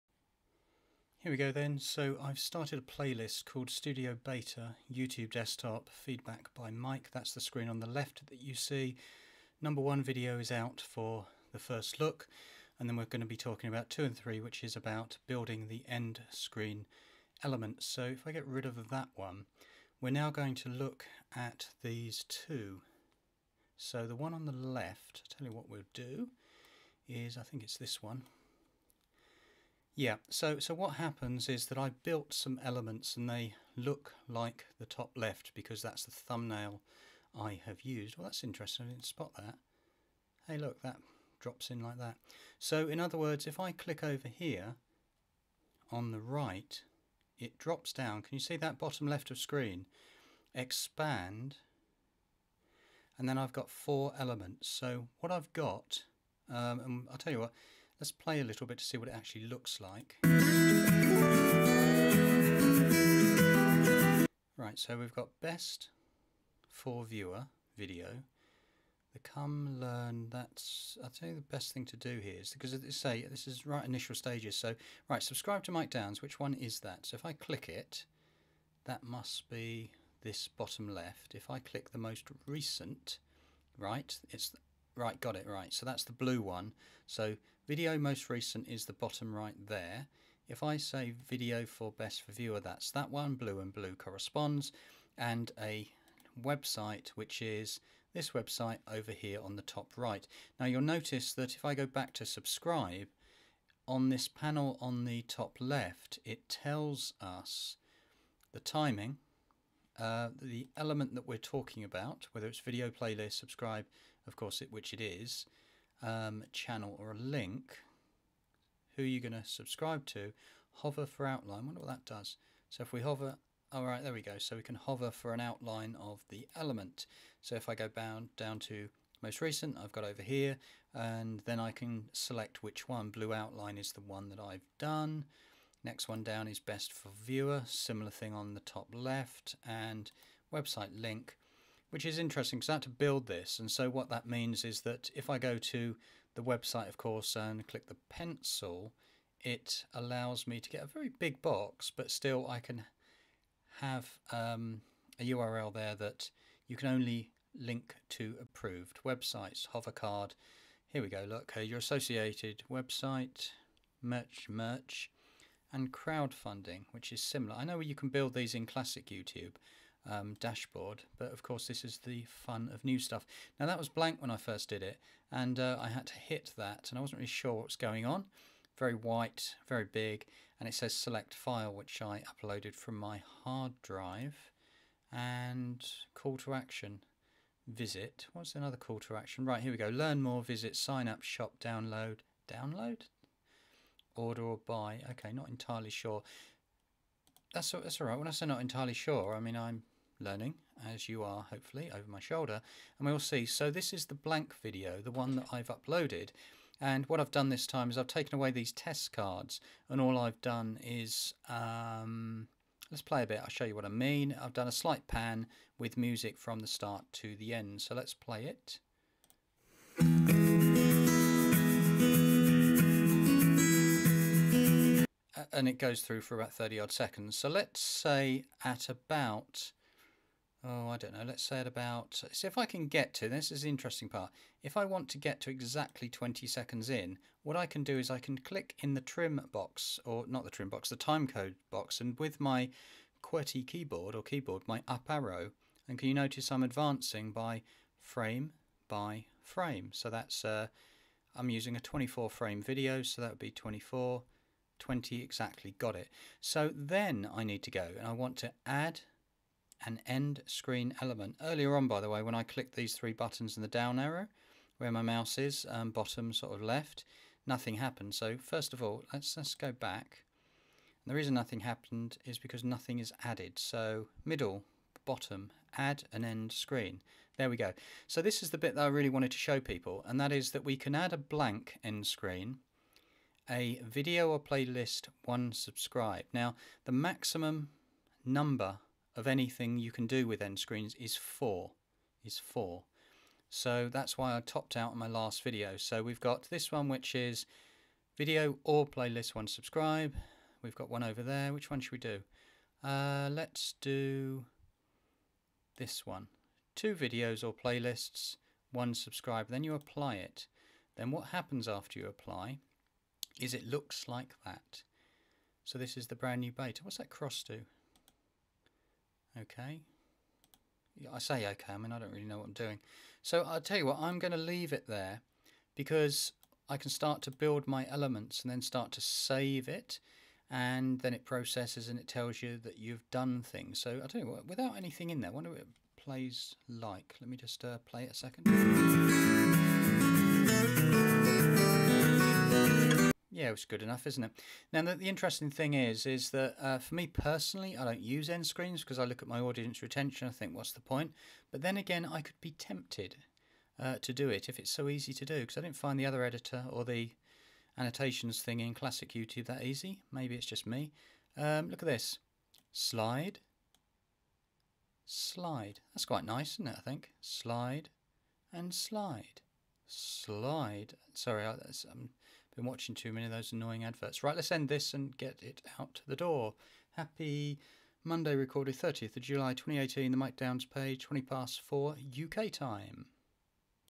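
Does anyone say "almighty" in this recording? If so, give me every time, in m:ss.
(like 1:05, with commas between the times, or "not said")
not said.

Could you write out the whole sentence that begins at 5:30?
And then it processes and it tells you that you've done things.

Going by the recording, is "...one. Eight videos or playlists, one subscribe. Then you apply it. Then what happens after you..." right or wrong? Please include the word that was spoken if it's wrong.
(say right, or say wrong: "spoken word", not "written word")
wrong: "Two", not "Eight".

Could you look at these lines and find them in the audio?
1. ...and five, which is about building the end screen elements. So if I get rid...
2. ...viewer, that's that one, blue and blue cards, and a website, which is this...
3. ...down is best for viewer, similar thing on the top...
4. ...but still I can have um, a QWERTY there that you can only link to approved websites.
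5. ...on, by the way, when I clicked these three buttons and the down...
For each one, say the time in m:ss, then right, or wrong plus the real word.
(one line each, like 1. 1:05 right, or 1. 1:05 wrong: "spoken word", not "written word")
1. 0:14 wrong: "three", not "five"
2. 1:32 wrong: "corresponds", not "cards"
3. 2:16 right
4. 2:31 wrong: "URL", not "QWERTY"
5. 4:21 right.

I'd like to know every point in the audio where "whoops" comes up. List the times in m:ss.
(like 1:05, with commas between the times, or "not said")
not said.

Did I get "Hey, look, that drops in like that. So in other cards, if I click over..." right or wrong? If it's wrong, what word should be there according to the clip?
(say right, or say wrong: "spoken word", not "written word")
wrong: "words", not "cards".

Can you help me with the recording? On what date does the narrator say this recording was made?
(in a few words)
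30th of July 2018.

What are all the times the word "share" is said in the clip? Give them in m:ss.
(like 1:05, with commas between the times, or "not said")
not said.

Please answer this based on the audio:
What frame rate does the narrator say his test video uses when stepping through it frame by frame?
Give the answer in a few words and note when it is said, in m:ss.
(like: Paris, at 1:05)
24, at 4:11.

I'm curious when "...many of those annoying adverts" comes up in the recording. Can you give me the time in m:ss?
6:13.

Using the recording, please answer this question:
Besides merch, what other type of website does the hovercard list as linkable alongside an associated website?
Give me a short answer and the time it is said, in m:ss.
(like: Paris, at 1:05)
Crowdfunding, at 2:45.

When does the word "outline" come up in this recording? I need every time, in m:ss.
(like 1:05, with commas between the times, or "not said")
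2:01, 2:05, 2:13.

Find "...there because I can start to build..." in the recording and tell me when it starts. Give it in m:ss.
5:24.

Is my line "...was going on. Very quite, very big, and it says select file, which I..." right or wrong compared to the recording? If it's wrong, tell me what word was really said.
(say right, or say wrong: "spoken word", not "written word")
wrong: "white", not "quite".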